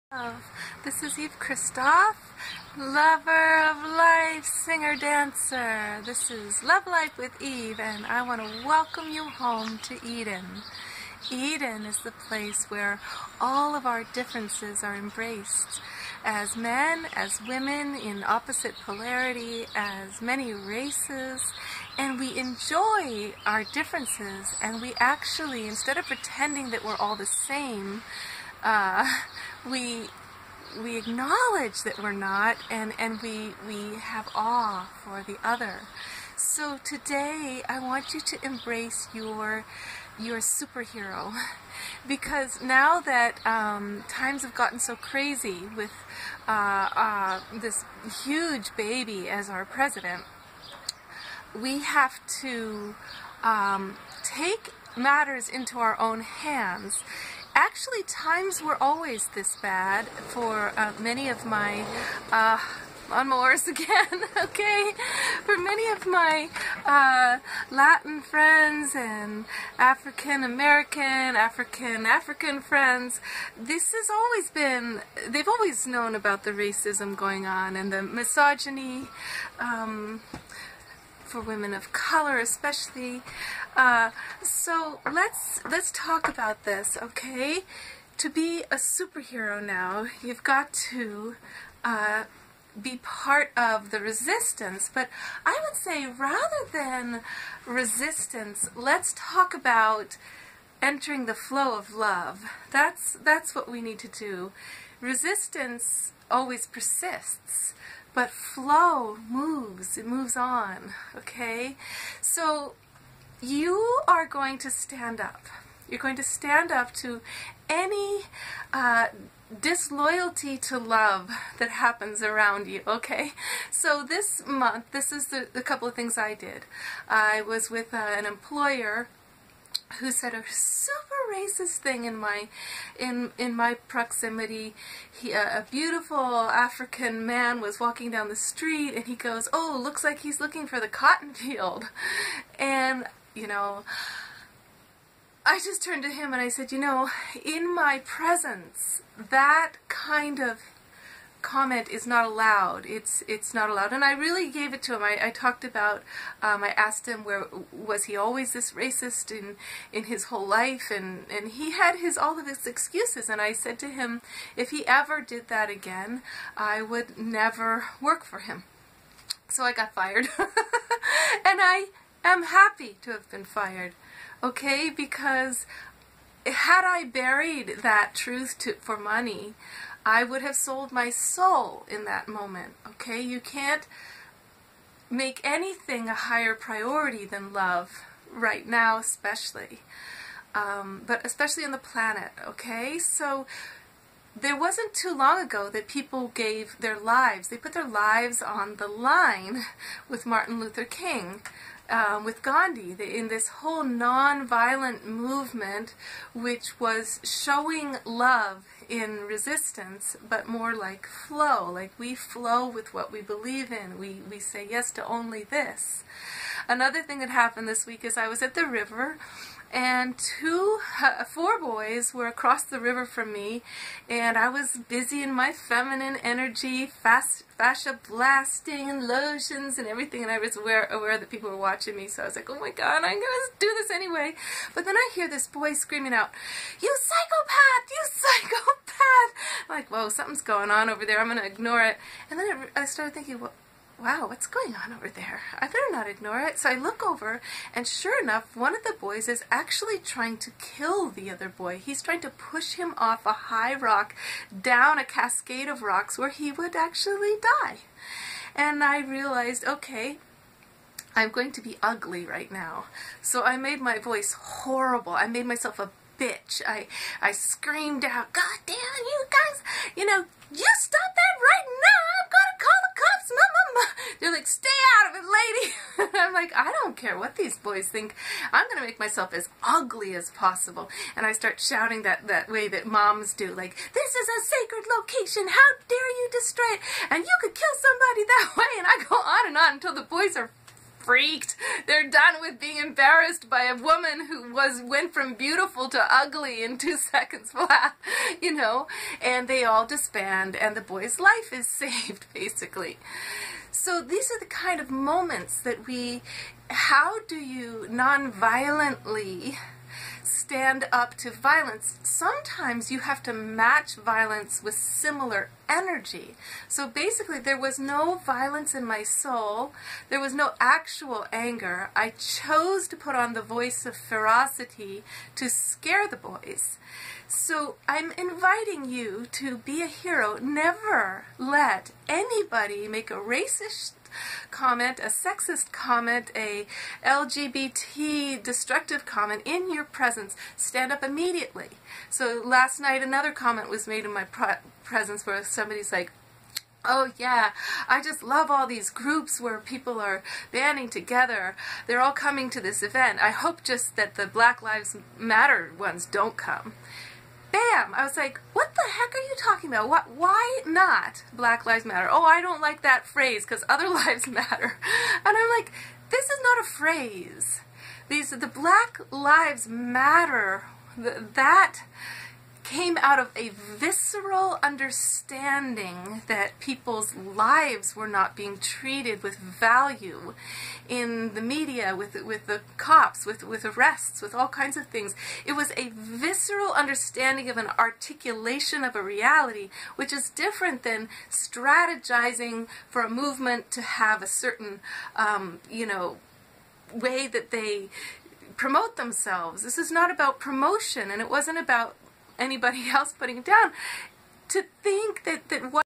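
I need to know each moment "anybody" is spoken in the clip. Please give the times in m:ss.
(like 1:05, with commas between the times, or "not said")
5:32, 6:42.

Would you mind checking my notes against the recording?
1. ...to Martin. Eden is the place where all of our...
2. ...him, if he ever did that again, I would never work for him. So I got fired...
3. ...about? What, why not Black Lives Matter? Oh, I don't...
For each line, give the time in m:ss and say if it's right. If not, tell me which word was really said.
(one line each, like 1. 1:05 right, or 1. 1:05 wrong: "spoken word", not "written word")
1. 0:09 wrong: "Eden", not "Martin"
2. 2:43 right
3. 5:59 right.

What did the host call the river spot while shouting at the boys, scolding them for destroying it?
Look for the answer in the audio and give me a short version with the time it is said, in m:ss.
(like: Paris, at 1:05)
a sacred location, at 4:44.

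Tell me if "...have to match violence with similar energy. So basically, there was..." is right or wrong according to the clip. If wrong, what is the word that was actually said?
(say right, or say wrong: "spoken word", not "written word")
right.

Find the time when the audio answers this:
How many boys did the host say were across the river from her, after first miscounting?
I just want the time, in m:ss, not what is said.
3:41.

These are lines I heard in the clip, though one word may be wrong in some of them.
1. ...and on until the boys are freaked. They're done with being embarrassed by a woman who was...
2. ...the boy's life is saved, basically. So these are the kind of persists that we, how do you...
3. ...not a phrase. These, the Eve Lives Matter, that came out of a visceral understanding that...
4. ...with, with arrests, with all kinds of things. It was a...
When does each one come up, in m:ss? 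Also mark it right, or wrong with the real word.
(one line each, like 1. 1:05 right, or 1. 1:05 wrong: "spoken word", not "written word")
1. 4:49 right
2. 5:00 wrong: "moments", not "persists"
3. 6:06 wrong: "Black", not "Eve"
4. 6:23 right.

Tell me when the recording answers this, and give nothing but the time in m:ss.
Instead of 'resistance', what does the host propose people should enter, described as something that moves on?
1:41.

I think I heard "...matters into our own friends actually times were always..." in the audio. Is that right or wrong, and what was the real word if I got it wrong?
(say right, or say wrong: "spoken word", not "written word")
wrong: "hands", not "friends".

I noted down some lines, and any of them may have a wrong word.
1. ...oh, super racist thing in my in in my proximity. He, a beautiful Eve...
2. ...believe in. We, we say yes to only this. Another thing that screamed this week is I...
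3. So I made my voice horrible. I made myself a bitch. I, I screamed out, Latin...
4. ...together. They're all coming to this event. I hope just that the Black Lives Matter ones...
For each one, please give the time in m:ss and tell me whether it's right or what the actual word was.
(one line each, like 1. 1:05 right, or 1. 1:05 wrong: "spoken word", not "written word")
1. 2:10 wrong: "African", not "Eve"
2. 3:33 wrong: "happened", not "screamed"
3. 4:23 wrong: "God", not "Latin"
4. 5:50 right.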